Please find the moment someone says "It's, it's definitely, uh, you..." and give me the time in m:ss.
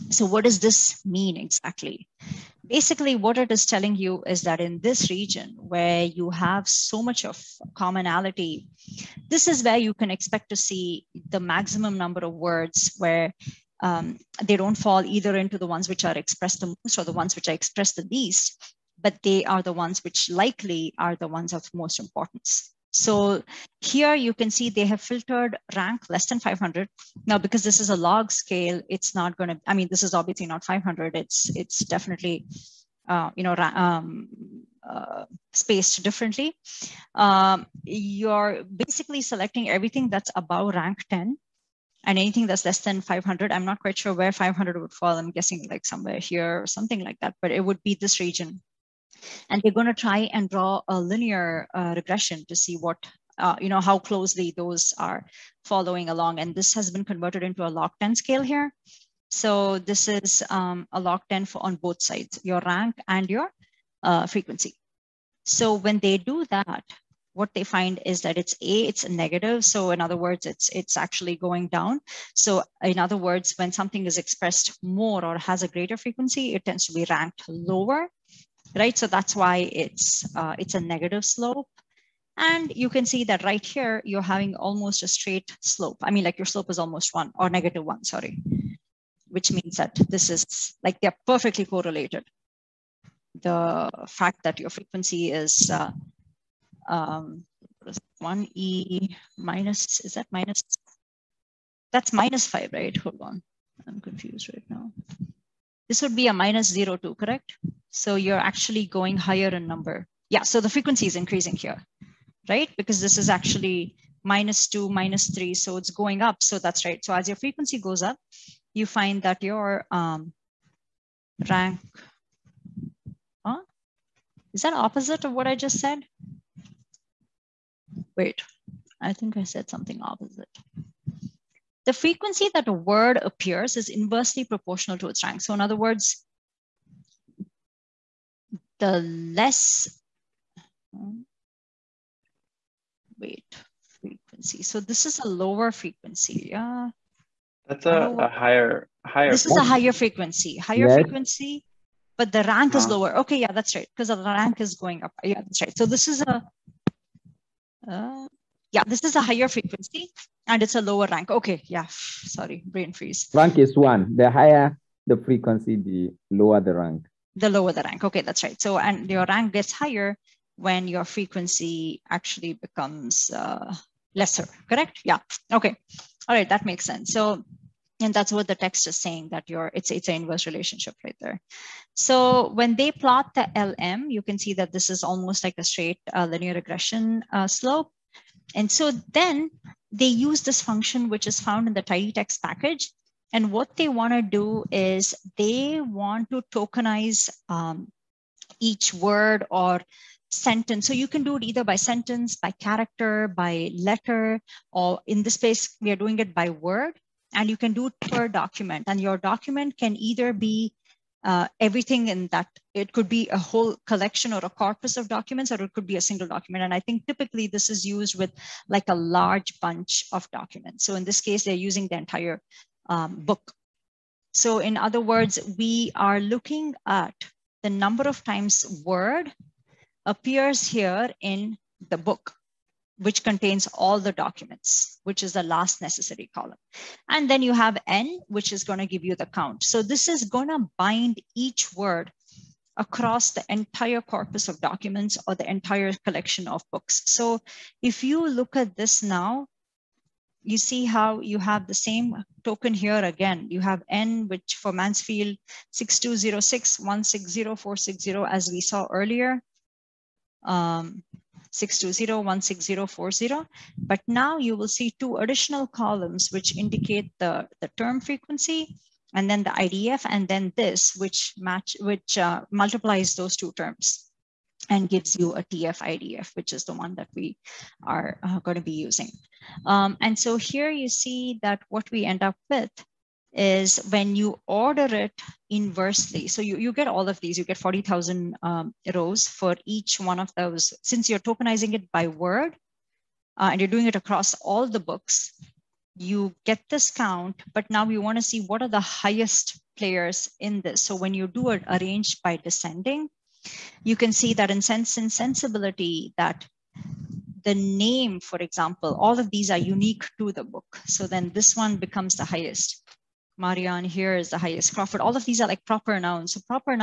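0:31.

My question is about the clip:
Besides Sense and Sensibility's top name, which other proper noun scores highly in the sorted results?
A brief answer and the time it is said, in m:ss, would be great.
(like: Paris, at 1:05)
Crawford, at 5:14.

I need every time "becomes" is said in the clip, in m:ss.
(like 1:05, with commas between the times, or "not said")
2:52, 5:11.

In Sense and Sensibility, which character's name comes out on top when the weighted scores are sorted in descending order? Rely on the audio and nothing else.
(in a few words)
Marianne.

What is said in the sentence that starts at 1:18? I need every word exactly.
So that's why it's, uh, it's a negative slope.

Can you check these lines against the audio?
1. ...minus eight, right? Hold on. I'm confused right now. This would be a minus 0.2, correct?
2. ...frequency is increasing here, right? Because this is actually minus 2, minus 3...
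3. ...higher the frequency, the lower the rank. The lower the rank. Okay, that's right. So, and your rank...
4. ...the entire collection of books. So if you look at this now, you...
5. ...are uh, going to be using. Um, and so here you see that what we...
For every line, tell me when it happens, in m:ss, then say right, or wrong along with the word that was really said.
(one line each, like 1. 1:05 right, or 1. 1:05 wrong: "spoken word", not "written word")
1. 1:42 wrong: "five", not "eight"
2. 1:50 right
3. 2:44 right
4. 4:05 right
5. 4:37 right.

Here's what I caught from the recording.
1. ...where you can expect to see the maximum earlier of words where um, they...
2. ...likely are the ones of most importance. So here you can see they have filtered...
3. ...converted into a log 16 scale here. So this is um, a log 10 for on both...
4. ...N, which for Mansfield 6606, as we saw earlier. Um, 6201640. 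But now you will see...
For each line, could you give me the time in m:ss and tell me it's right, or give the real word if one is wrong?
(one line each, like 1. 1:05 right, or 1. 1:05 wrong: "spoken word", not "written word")
1. 0:09 wrong: "number", not "earlier"
2. 0:20 right
3. 0:57 wrong: "10", not "16"
4. 4:13 wrong: "6206", not "6606".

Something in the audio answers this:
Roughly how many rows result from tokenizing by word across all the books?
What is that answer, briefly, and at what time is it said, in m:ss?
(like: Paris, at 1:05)
40,000, at 4:47.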